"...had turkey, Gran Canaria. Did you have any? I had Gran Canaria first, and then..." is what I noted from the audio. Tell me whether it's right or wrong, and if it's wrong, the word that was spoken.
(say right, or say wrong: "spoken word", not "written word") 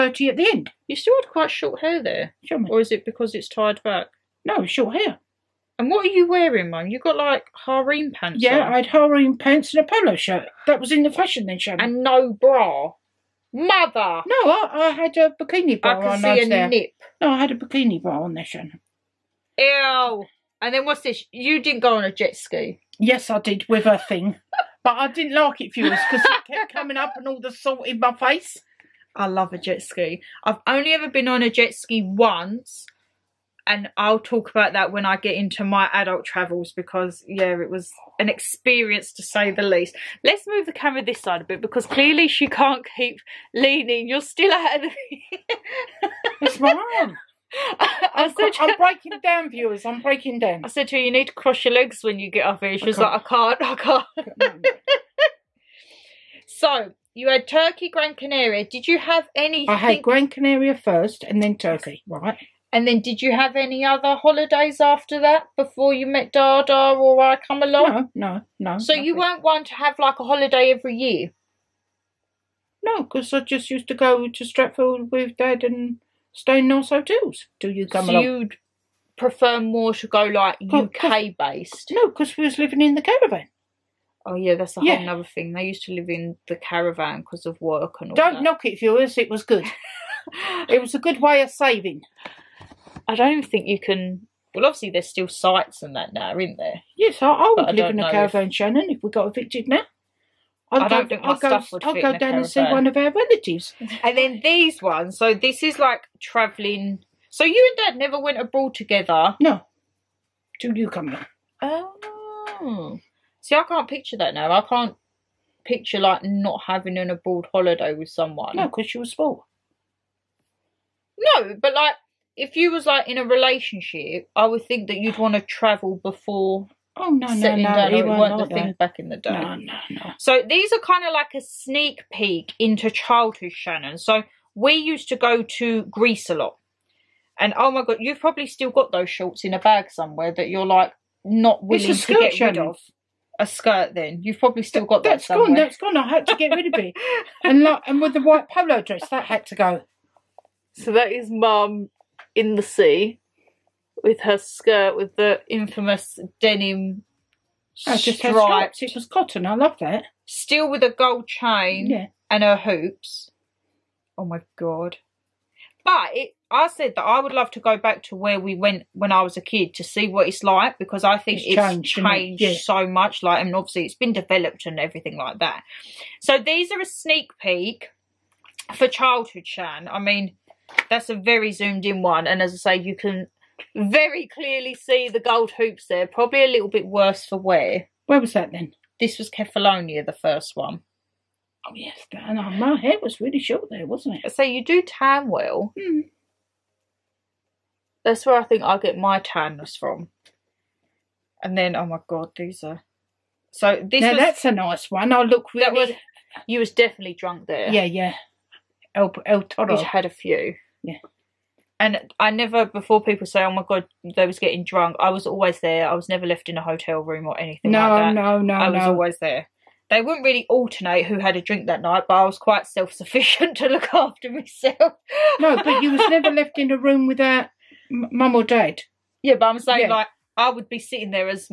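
right.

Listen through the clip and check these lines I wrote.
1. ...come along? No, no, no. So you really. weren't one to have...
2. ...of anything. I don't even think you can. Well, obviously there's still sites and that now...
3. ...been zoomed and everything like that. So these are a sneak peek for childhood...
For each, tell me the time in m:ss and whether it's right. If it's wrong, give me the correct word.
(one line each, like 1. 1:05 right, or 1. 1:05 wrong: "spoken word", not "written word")
1. 1:07 right
2. 1:31 wrong: "saving", not "anything"
3. 2:53 wrong: "developed", not "zoomed".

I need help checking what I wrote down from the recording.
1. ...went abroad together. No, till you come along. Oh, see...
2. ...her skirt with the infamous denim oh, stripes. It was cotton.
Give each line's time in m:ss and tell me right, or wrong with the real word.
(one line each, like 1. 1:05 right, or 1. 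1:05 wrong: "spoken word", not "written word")
1. 1:48 right
2. 2:34 right.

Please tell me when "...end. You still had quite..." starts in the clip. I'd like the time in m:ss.
0:00.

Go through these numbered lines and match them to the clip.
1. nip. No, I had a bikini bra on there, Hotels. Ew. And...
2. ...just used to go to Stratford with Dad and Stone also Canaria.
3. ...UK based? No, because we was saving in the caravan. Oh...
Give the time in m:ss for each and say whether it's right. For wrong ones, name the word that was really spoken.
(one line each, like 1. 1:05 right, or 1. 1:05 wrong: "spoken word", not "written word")
1. 0:16 wrong: "Shannon", not "Hotels"
2. 1:13 wrong: "Hotels", not "Canaria"
3. 1:20 wrong: "living", not "saving".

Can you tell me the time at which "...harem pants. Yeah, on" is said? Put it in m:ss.
0:07.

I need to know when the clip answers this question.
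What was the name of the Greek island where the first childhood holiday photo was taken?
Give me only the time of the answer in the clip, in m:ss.
3:09.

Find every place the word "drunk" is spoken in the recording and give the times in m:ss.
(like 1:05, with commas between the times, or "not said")
3:27, 3:34.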